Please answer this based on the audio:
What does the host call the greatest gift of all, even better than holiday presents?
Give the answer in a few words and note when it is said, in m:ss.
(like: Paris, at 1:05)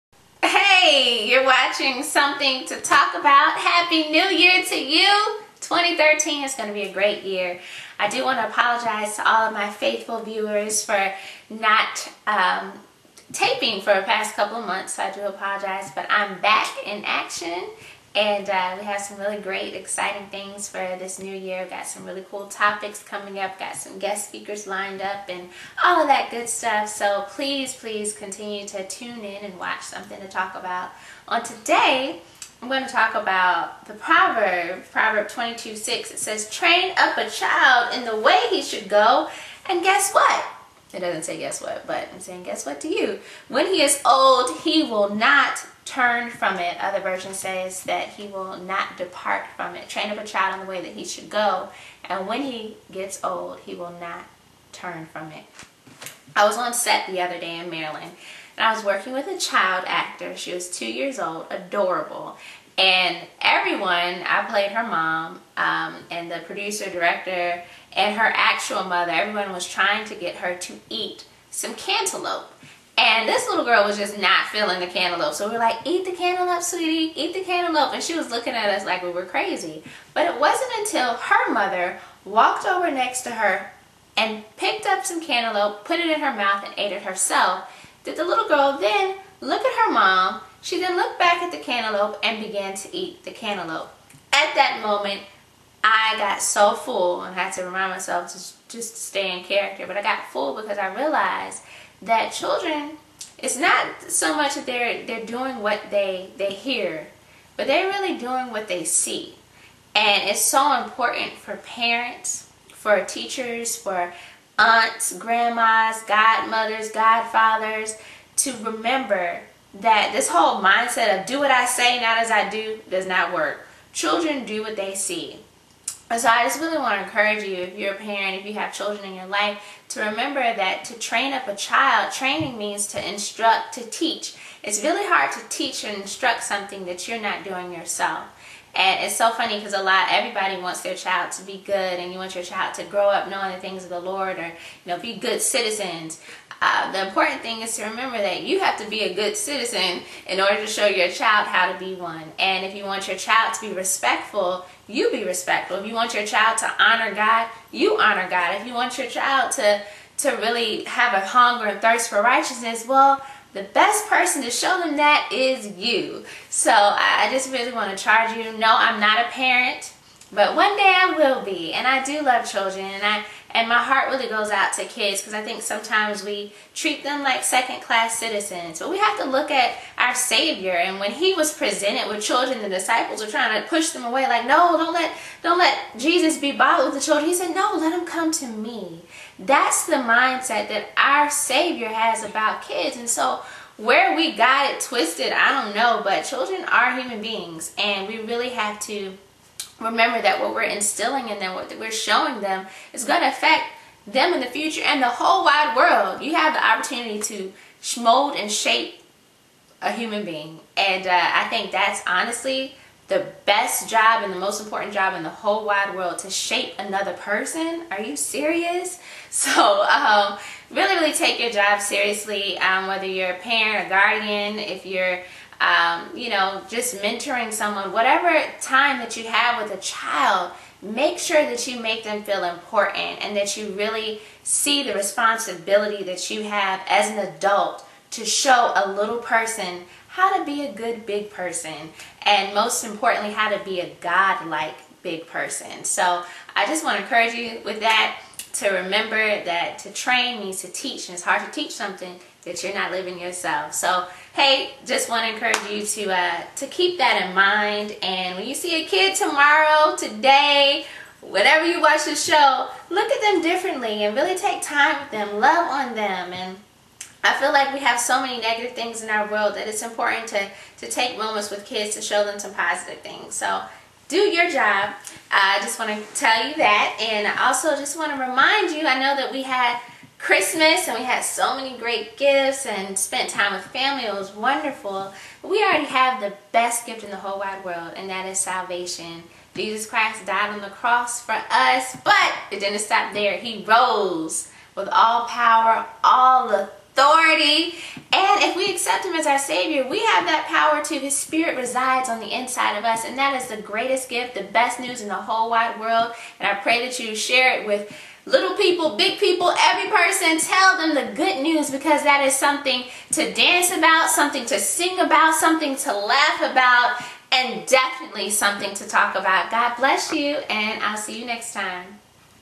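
Salvation, at 4:48.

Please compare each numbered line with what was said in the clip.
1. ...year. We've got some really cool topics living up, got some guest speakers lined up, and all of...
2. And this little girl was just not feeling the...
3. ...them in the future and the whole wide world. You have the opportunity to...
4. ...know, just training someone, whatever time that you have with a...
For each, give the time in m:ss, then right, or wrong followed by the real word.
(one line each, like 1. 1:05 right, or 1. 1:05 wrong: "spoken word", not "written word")
1. 0:21 wrong: "coming", not "living"
2. 1:12 right
3. 3:24 right
4. 3:46 wrong: "mentoring", not "training".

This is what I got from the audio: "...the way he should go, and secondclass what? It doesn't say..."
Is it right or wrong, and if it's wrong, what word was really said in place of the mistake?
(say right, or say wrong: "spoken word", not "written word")
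wrong: "guess", not "secondclass".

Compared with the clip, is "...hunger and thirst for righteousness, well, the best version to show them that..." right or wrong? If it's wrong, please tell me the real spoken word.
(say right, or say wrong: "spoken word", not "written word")
wrong: "person", not "version".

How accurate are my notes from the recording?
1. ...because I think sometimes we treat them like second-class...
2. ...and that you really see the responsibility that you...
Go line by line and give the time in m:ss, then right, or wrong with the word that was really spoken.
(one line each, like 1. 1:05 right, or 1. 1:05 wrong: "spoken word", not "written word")
1. 2:55 right
2. 3:53 right.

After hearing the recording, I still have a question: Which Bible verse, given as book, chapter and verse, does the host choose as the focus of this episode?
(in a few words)
Proverbs 22:6.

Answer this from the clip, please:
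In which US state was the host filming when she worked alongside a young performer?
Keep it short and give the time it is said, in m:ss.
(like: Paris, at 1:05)
Maryland, at 0:57.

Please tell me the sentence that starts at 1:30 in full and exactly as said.
She then looked back at the cantaloupe and began to eat the cantaloupe.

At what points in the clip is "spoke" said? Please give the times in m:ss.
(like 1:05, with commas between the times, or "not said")
not said.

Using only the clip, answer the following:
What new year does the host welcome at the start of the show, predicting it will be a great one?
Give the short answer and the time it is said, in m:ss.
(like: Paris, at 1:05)
2013, at 0:05.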